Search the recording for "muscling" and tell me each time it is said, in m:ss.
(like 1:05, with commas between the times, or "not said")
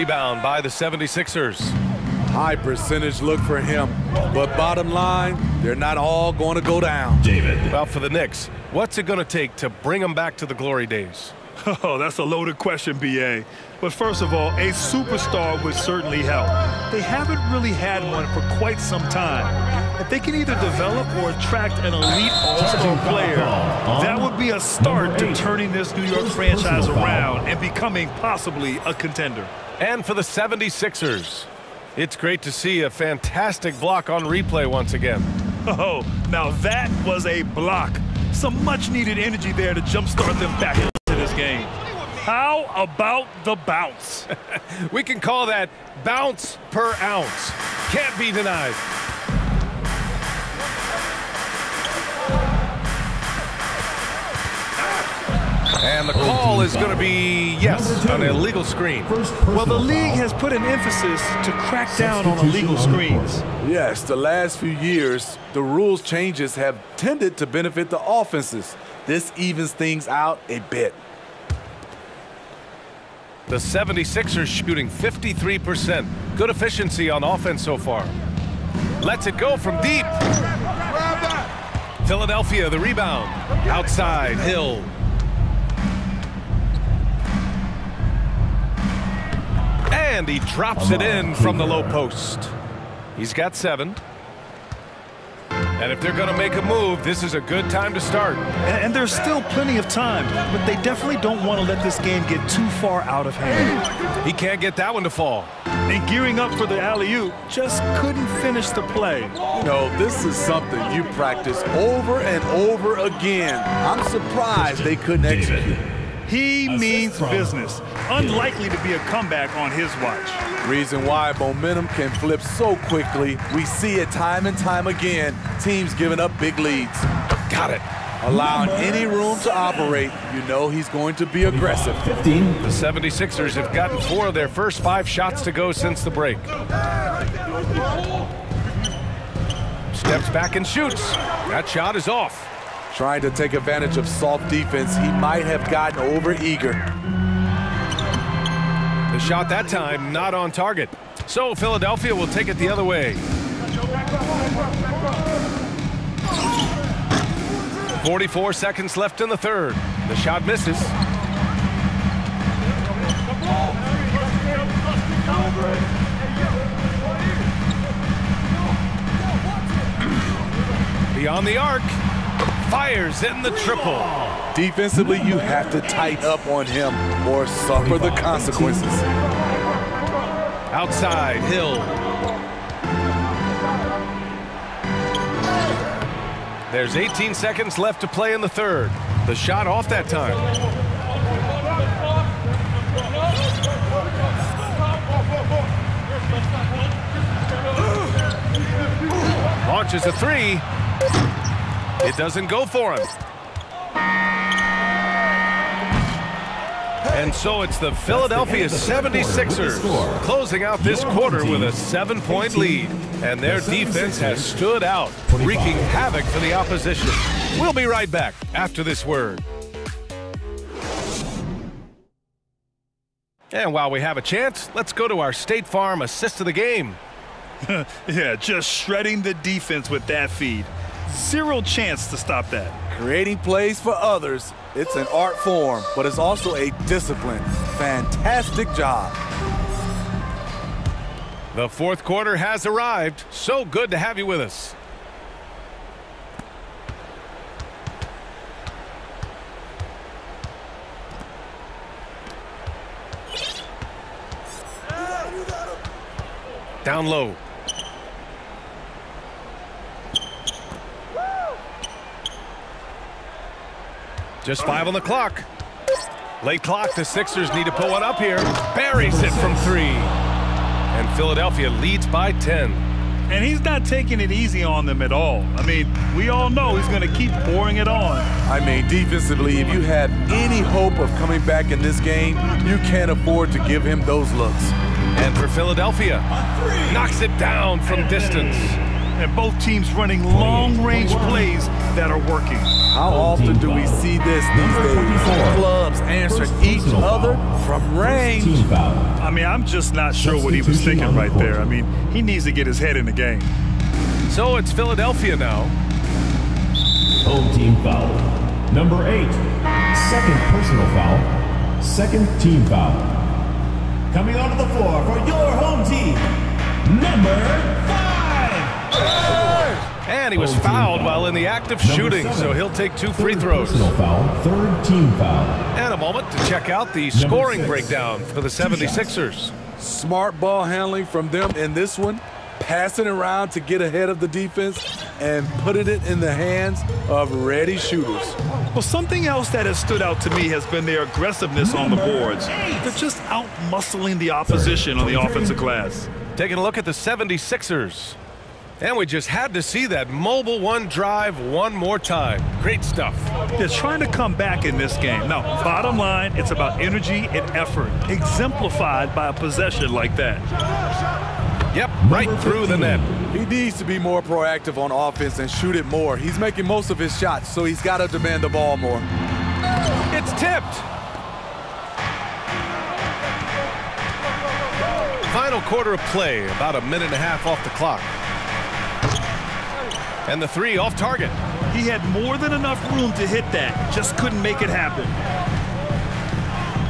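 5:43.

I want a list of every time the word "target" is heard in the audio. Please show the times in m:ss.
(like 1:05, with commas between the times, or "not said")
2:30, 6:20.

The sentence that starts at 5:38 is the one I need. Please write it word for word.
Well, something else that has stood out to me has been their aggressiveness on the boards.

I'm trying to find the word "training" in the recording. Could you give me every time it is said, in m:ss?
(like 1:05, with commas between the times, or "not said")
not said.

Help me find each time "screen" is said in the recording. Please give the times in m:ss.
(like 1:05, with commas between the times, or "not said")
0:58, 1:02.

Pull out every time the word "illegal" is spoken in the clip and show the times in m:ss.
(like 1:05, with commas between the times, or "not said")
0:58, 1:02.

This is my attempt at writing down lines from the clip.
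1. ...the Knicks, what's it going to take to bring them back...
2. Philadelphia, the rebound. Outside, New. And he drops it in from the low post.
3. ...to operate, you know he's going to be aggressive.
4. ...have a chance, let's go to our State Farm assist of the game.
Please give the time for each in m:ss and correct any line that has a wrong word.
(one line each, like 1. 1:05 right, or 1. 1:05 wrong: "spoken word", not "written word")
1. 0:07 right
2. 1:22 wrong: "Hill", not "New"
3. 2:09 right
4. 3:43 right.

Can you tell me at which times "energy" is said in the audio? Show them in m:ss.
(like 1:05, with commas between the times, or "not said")
0:39, 5:56.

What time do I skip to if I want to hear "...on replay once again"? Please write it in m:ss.
0:34.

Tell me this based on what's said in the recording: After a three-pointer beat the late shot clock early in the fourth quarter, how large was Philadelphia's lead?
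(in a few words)
10.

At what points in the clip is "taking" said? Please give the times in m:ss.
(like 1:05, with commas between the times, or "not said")
4:33, 5:46.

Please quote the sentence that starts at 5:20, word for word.
And he was fouled while in the act of shooting, so he'll take two free throws.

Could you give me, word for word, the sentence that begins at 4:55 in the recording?
Clubs answering each other from range.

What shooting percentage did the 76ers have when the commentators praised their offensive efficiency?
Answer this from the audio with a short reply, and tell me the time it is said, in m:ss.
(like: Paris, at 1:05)
53%, at 1:14.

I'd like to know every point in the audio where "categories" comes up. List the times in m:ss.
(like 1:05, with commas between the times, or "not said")
not said.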